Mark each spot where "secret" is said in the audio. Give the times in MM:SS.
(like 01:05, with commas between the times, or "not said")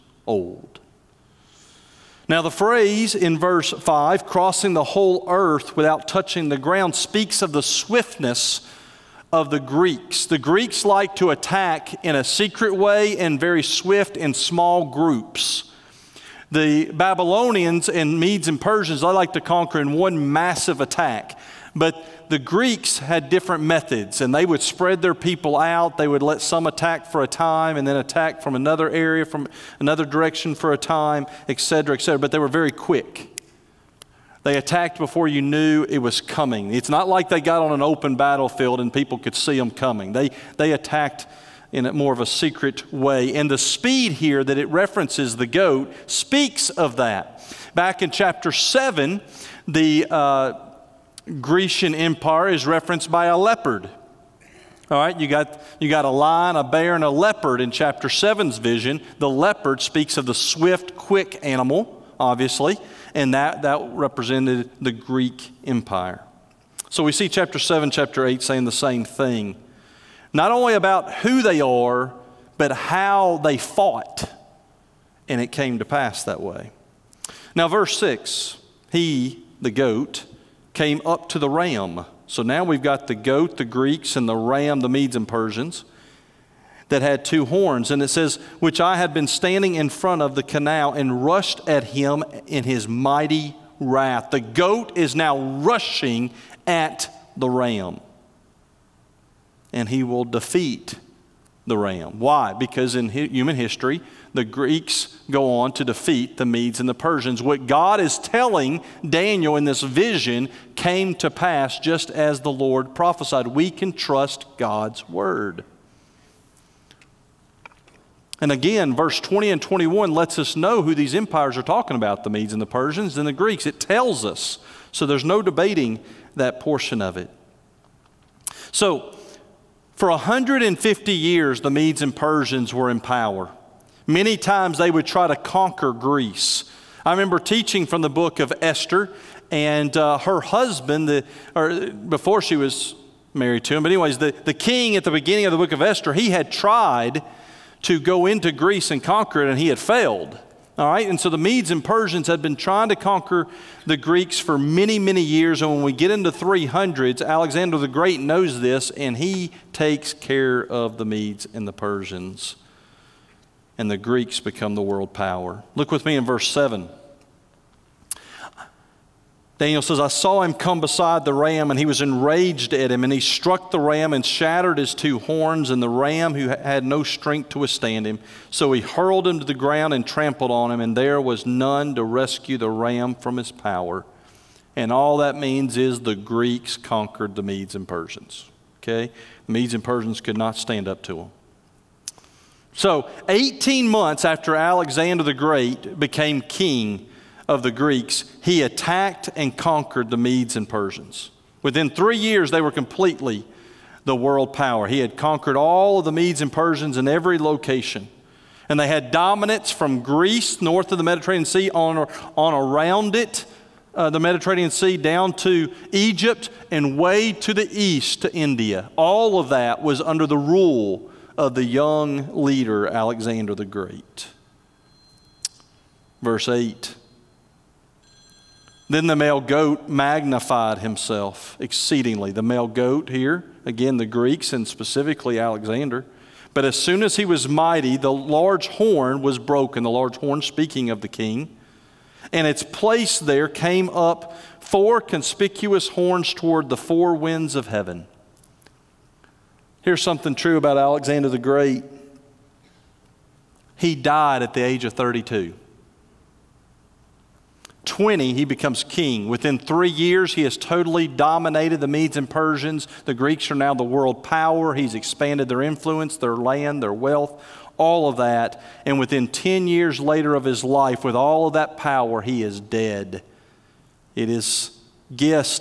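00:12, 00:42.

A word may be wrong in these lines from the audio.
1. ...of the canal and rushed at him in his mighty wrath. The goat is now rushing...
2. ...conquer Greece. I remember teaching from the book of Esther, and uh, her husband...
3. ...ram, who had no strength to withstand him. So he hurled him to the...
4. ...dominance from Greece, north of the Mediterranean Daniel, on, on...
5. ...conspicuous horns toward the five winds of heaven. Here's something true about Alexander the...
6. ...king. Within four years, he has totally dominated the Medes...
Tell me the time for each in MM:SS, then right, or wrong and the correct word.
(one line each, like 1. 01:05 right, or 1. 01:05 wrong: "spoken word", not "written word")
1. 01:30 right
2. 02:15 right
3. 02:55 right
4. 03:29 wrong: "Sea", not "Daniel"
5. 04:04 wrong: "four", not "five"
6. 04:18 wrong: "three", not "four".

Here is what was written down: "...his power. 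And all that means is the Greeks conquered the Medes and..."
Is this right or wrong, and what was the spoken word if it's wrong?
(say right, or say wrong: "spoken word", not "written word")
right.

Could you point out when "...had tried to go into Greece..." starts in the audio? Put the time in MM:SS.
02:26.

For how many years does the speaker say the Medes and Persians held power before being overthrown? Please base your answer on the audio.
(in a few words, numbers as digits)
150.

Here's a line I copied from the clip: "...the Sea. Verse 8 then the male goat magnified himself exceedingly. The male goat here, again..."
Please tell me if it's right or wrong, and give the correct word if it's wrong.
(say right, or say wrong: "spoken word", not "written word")
wrong: "Great", not "Sea".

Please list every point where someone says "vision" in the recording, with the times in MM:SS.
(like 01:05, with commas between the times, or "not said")
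00:58, 01:49.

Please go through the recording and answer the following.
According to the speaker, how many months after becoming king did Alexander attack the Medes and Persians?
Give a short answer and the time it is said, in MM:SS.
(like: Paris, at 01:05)
18, at 03:13.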